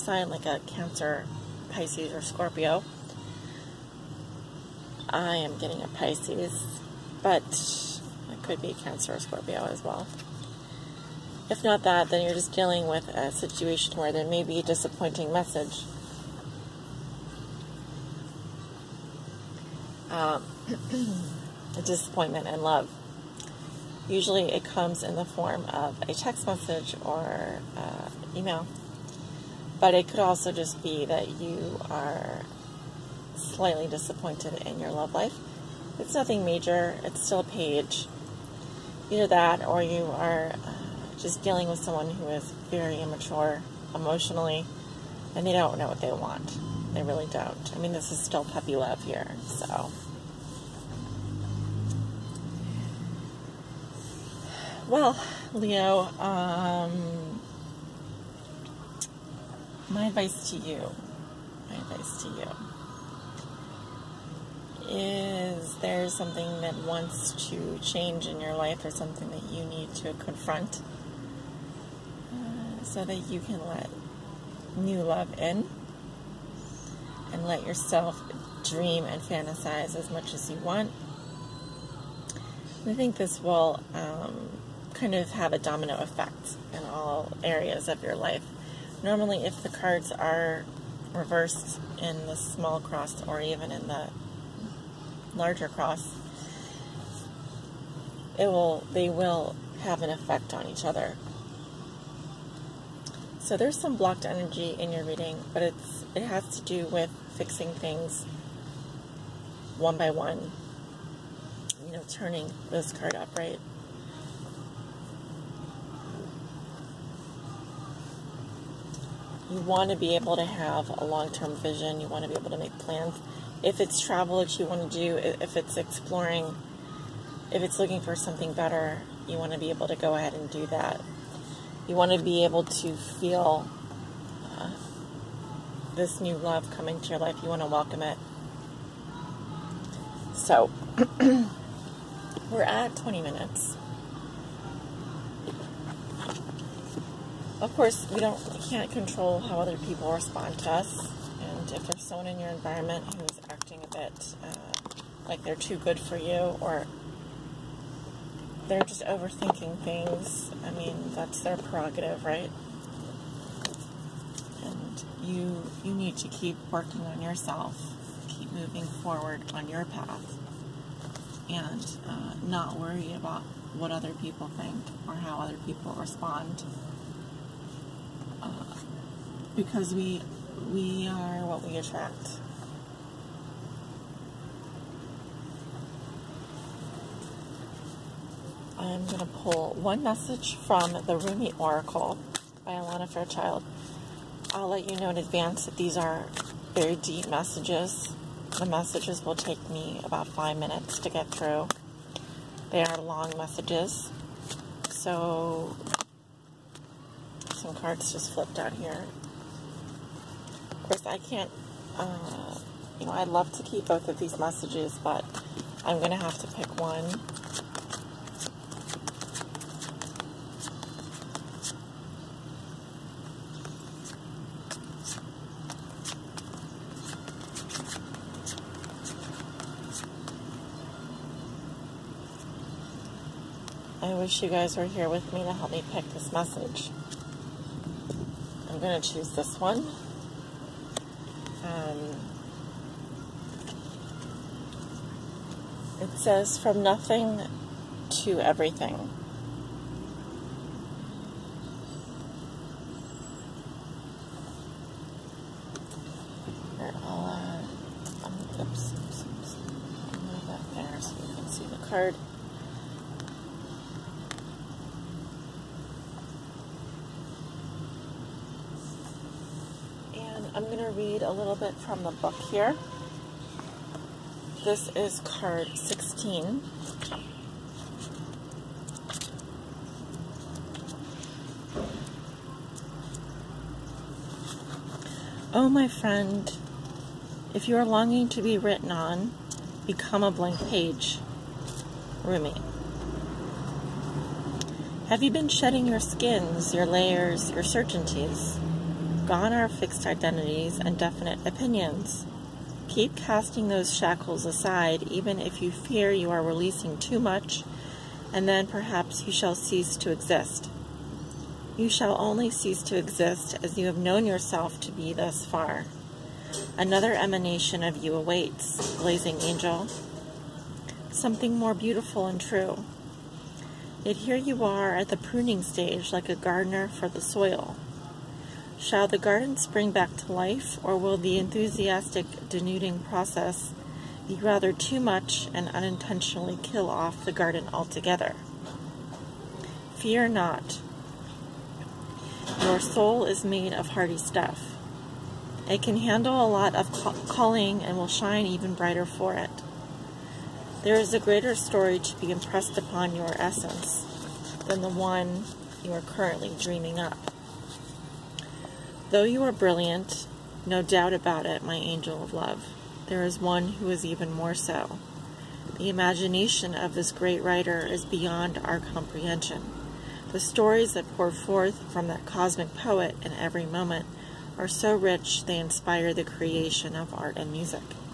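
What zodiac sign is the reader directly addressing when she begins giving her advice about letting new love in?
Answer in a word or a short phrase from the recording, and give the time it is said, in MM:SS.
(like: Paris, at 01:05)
Leo, at 00:54.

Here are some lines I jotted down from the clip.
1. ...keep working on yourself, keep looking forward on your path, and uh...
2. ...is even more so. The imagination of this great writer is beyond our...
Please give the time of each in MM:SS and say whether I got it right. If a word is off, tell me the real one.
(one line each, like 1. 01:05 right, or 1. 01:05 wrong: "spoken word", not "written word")
1. 02:46 wrong: "moving", not "looking"
2. 06:03 right.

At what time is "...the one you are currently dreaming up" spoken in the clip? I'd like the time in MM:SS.
05:54.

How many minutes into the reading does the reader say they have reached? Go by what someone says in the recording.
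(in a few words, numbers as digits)
20.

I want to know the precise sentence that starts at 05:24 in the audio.
Yet here you are at the pruning stage like a gardener for the soil.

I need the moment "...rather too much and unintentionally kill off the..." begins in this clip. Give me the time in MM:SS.
05:34.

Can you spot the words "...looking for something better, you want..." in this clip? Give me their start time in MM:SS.
02:07.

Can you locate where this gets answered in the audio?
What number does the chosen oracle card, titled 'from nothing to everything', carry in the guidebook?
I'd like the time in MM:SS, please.
04:35.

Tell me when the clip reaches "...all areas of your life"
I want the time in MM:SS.
01:26.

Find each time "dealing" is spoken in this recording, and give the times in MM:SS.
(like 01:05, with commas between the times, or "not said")
00:12, 00:41.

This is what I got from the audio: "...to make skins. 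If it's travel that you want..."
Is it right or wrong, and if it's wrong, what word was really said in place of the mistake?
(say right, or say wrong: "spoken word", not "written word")
wrong: "plans", not "skins".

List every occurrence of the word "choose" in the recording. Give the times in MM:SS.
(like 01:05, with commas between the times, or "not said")
03:59.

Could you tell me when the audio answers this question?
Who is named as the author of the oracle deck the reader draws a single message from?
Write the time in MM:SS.
03:12.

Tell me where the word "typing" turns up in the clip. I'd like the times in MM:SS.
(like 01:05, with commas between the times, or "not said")
not said.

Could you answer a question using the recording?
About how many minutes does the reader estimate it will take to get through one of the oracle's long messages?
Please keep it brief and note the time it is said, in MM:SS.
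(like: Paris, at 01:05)
5, at 03:20.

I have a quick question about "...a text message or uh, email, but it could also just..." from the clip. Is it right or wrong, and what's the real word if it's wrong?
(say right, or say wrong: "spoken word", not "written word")
right.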